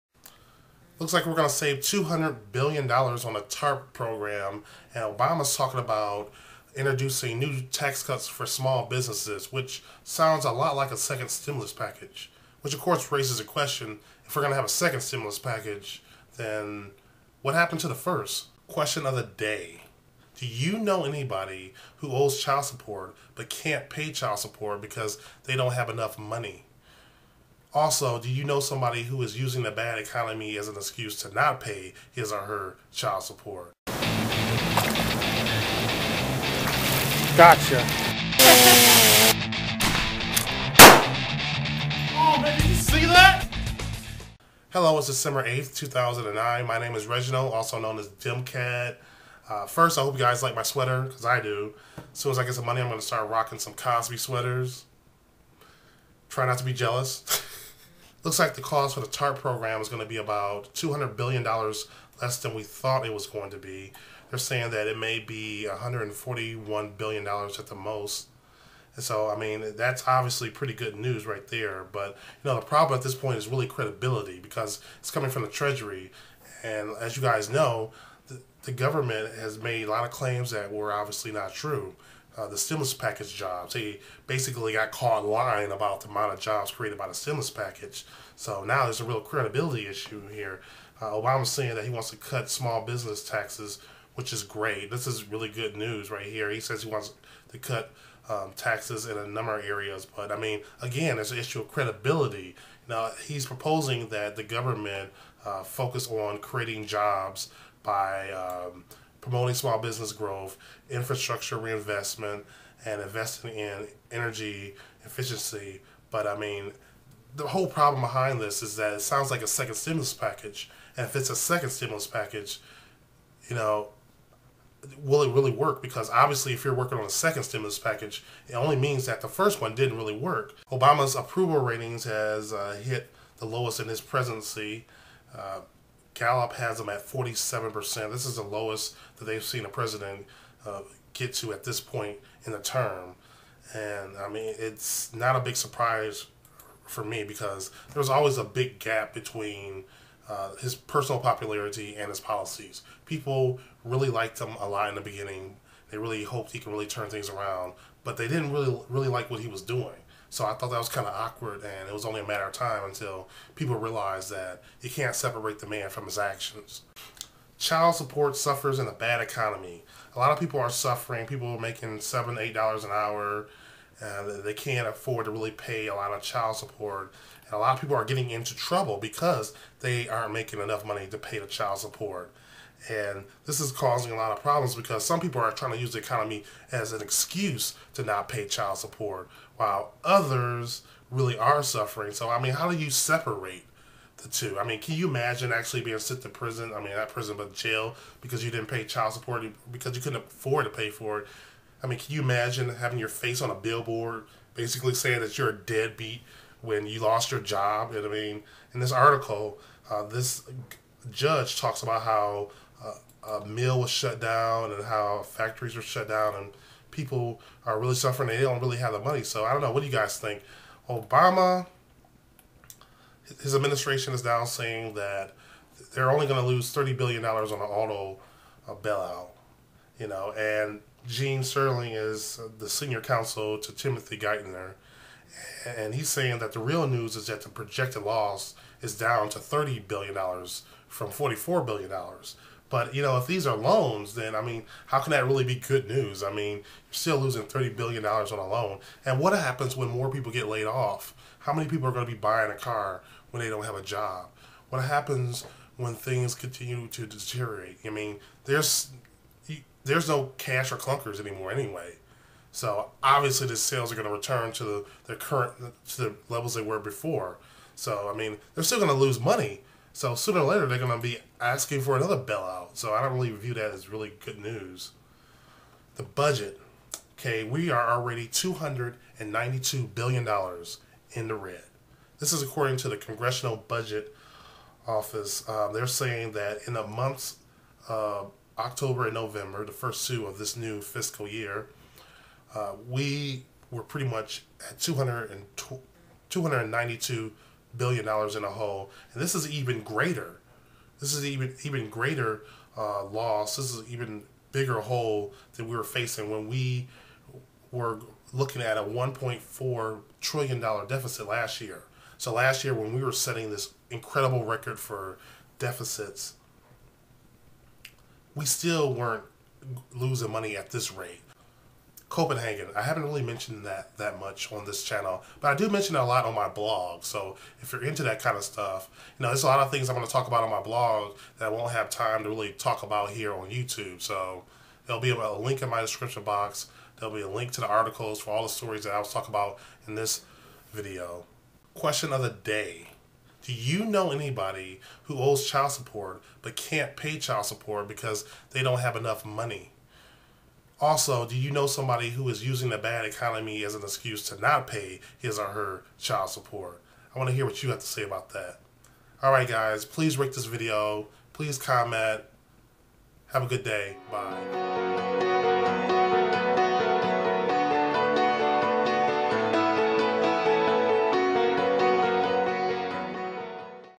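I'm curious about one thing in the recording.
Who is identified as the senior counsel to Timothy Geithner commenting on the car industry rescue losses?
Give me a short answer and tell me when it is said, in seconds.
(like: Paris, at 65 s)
Gene Sperling, at 231 s.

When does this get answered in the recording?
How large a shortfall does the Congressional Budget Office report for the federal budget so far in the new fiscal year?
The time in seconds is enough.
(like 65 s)
278 s.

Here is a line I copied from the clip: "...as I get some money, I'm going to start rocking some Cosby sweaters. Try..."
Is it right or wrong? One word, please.
right.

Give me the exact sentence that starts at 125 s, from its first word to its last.
Because obviously, if you're working on a second stimulus package, it only means that the first one didn't really work.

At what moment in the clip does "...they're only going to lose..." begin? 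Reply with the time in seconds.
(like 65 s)
225 s.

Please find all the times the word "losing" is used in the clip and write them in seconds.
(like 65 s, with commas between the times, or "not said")
247 s, 319 s.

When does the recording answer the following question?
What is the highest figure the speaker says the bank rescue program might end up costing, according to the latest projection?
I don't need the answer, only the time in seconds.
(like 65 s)
65 s.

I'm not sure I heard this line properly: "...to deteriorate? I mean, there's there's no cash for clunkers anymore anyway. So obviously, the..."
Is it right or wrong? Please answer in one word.
right.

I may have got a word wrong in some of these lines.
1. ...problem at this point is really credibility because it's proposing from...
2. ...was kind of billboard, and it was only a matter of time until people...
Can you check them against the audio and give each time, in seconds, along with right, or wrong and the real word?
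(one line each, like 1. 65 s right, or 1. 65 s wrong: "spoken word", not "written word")
1. 72 s wrong: "coming", not "proposing"
2. 160 s wrong: "awkward", not "billboard".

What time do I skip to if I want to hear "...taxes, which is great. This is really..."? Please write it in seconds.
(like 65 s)
93 s.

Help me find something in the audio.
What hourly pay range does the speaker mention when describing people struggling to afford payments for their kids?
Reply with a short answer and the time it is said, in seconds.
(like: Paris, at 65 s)
$7-8 an hour, at 171 s.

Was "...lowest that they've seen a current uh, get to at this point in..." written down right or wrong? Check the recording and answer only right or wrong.
wrong.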